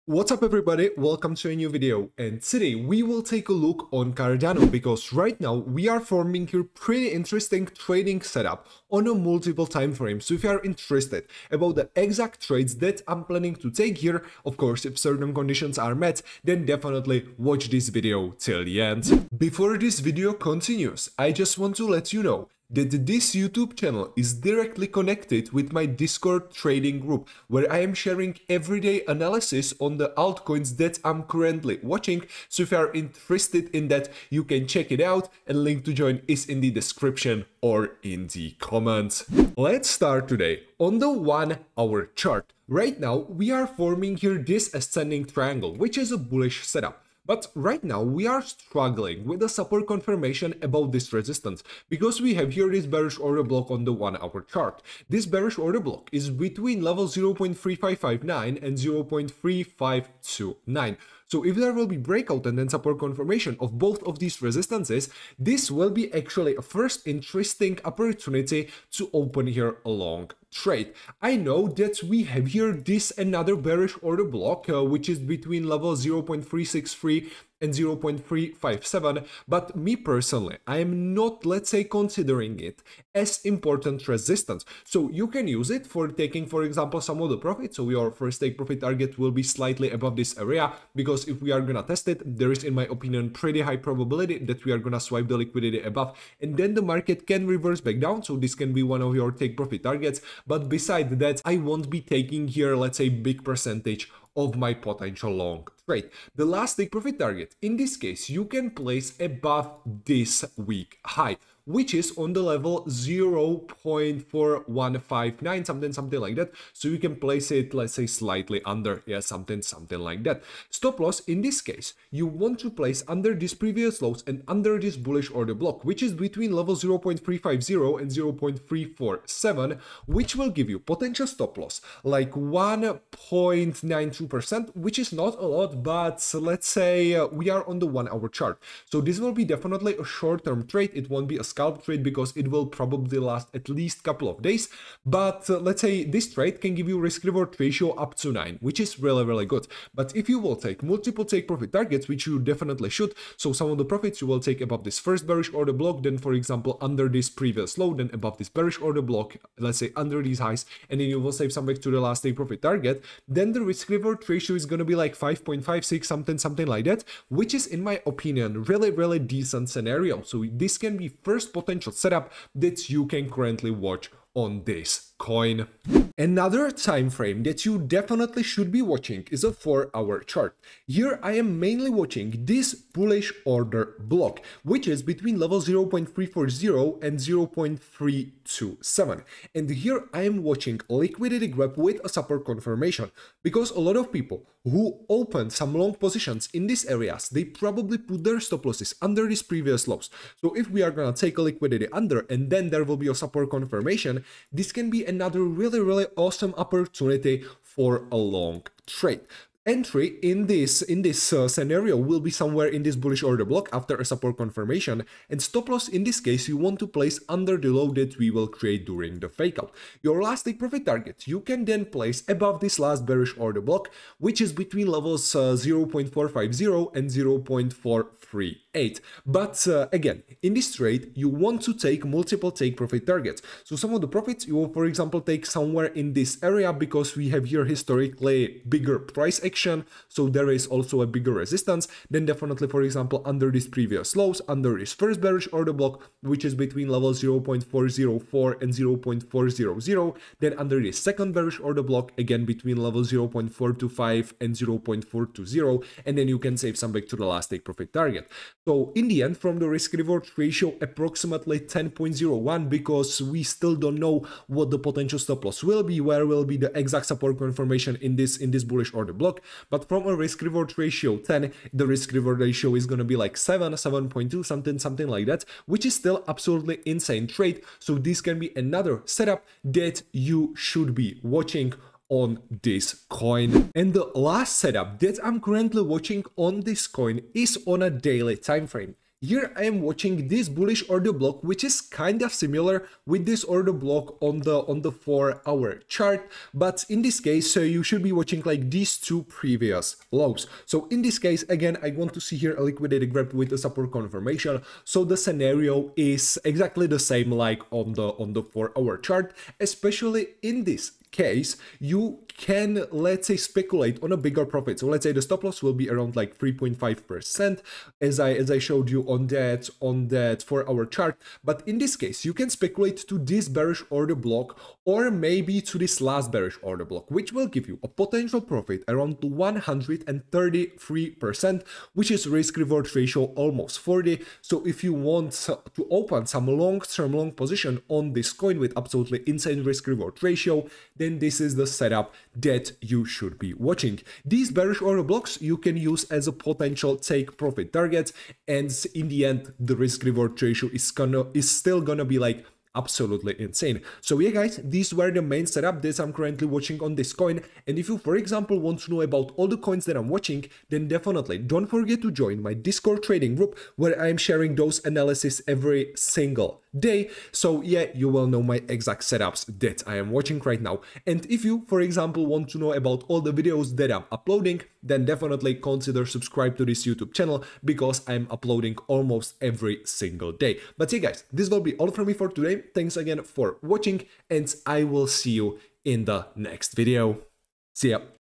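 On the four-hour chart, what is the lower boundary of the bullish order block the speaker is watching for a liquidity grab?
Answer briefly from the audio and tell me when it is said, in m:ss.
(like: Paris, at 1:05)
0.327, at 3:07.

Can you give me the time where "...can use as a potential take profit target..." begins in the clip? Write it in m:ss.
5:45.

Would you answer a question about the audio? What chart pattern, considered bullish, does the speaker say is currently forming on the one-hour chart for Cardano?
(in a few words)
Ascending triangle.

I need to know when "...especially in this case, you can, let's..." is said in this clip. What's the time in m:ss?
5:09.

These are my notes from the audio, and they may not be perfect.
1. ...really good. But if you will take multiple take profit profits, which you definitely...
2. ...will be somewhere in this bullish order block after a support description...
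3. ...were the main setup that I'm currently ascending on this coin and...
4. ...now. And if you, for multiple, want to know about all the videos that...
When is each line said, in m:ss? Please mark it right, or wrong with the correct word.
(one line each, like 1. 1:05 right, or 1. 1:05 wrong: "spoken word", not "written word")
1. 2:29 wrong: "targets", not "profits"
2. 3:31 wrong: "confirmation", not "description"
3. 5:54 wrong: "watching", not "ascending"
4. 6:10 wrong: "example", not "multiple".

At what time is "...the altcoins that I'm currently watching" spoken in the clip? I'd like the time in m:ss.
0:29.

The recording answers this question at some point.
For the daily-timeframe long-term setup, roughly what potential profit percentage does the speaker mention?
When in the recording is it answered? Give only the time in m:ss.
5:29.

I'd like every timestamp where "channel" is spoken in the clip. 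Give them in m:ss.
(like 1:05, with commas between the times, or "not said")
0:23, 6:17.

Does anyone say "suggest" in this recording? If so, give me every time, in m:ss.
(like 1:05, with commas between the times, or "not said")
not said.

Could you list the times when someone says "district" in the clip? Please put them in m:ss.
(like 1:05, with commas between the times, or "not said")
not said.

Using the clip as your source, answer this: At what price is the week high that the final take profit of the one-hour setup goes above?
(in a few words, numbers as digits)
0.4159.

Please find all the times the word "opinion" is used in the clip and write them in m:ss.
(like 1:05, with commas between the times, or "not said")
1:32, 2:48.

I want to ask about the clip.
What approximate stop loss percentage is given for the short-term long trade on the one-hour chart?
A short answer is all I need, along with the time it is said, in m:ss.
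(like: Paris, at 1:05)
1.92%, at 2:12.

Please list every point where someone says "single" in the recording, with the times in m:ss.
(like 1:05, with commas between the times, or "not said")
6:05, 6:19.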